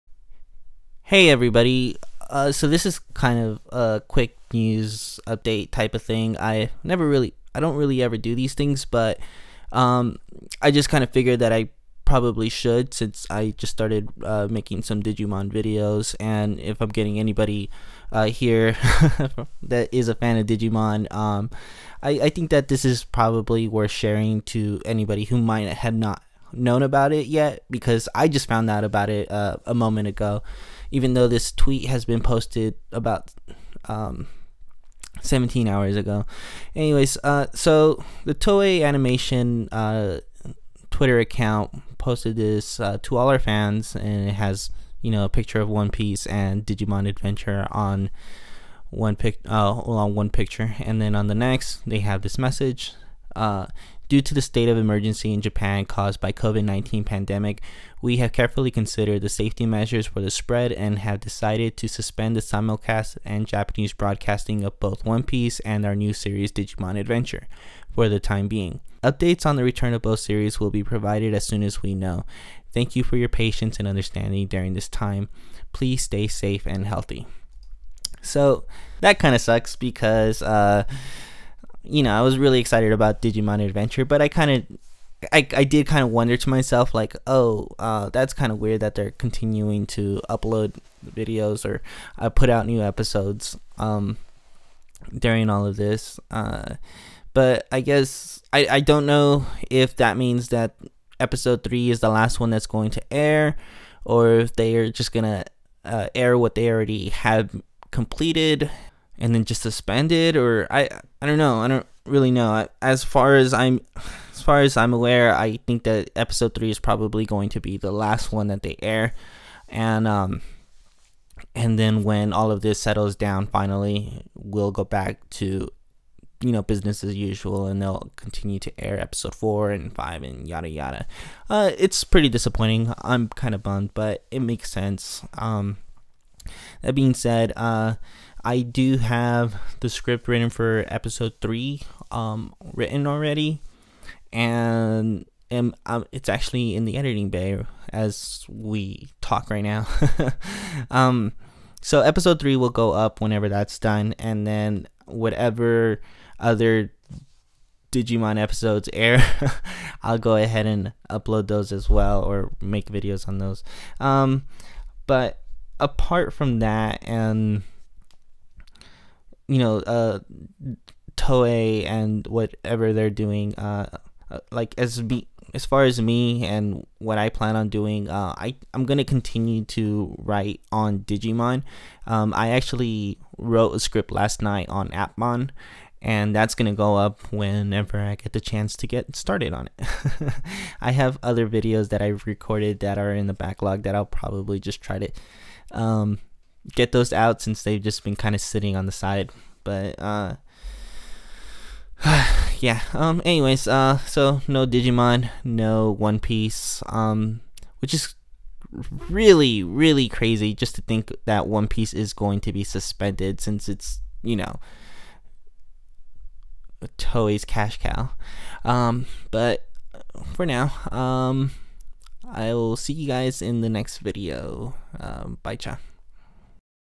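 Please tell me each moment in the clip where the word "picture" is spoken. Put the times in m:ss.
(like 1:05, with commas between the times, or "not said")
0:45, 0:50.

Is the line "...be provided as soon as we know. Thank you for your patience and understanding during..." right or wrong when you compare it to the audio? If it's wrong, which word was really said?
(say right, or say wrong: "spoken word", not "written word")
right.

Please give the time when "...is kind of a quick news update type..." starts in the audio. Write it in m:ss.
0:02.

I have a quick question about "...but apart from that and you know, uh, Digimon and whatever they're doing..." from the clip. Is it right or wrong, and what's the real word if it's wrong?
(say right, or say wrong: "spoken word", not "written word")
wrong: "Toei", not "Digimon".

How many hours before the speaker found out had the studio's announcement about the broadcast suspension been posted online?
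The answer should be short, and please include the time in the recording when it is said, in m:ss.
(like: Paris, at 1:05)
17, at 0:35.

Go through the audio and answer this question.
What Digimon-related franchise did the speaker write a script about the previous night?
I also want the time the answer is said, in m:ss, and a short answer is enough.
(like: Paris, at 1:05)
Appmon, at 3:04.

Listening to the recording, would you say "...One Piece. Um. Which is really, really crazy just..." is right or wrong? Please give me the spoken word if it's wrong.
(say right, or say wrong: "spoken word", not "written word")
right.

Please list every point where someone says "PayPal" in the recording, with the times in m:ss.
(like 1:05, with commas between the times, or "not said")
not said.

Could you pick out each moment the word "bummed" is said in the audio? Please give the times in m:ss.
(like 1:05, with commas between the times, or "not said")
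2:13.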